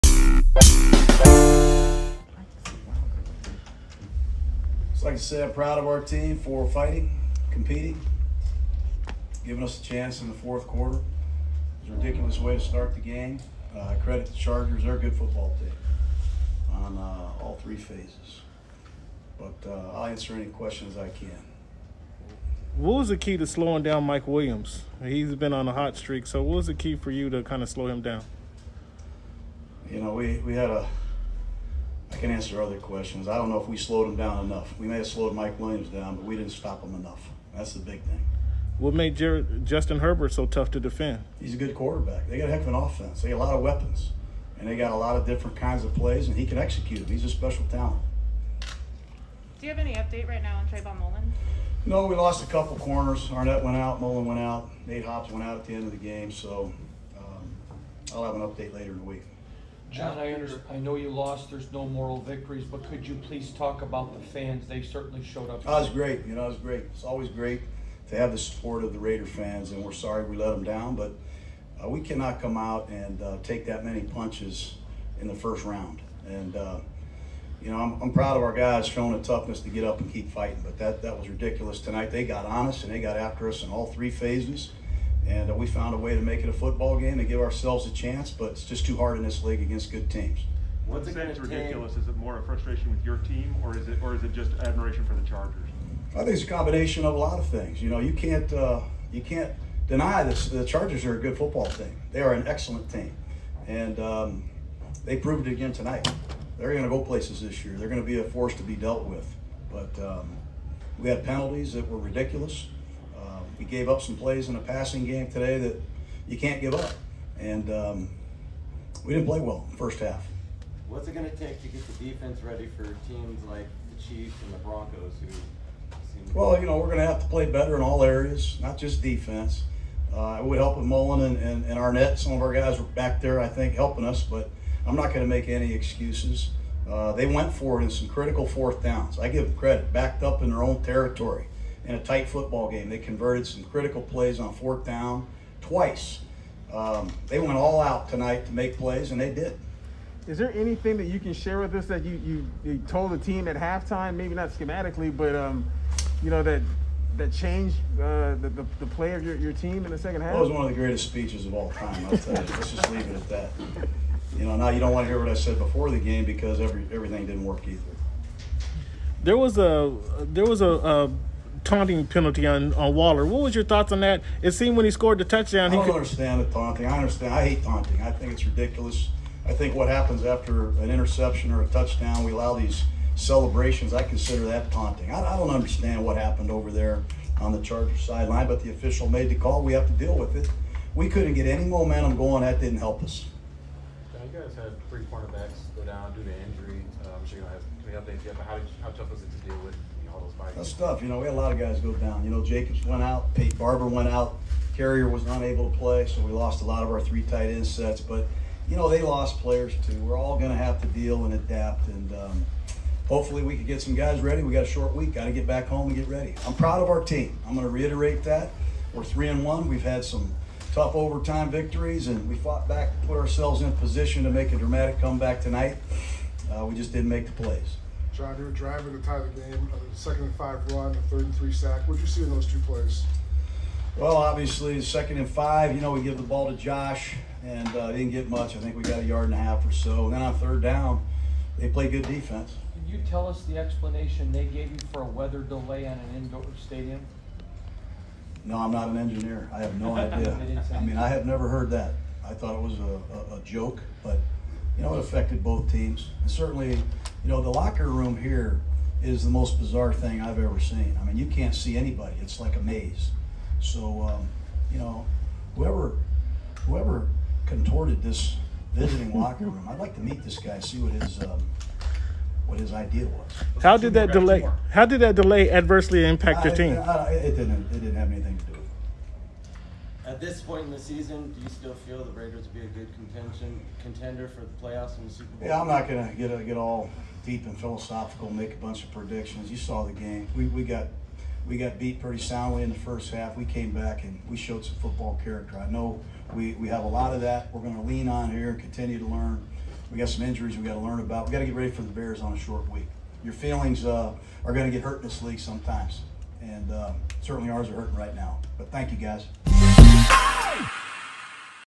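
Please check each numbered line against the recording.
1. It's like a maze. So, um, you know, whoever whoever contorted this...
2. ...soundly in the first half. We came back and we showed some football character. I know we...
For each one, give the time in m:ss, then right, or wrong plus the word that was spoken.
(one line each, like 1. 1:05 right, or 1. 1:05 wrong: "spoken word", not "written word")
1. 4:22 right
2. 4:52 right.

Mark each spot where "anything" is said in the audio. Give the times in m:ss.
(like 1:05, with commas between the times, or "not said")
2:30, 4:38.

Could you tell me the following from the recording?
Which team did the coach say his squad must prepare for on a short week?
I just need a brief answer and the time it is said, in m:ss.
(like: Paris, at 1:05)
Bears, at 5:01.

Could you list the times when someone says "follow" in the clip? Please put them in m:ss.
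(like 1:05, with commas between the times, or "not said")
not said.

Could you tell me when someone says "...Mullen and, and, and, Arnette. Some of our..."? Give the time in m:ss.
2:10.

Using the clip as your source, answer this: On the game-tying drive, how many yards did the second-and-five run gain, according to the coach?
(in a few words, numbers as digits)
1.5 yards.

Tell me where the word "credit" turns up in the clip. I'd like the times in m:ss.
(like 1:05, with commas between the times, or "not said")
0:14, 2:19.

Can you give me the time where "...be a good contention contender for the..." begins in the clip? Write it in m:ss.
4:42.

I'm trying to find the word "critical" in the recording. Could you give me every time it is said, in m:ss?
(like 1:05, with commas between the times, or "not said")
2:18, 2:23.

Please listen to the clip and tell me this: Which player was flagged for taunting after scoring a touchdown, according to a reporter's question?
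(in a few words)
Waller.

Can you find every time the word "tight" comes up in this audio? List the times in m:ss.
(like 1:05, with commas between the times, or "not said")
2:21, 3:27.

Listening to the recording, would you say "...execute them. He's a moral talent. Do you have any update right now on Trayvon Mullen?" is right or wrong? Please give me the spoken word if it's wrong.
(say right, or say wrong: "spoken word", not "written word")
wrong: "special", not "moral".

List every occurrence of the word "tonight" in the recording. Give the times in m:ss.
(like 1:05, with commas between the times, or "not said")
1:21, 1:45, 2:28, 3:45.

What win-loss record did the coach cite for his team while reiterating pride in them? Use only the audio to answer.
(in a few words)
3 and 1.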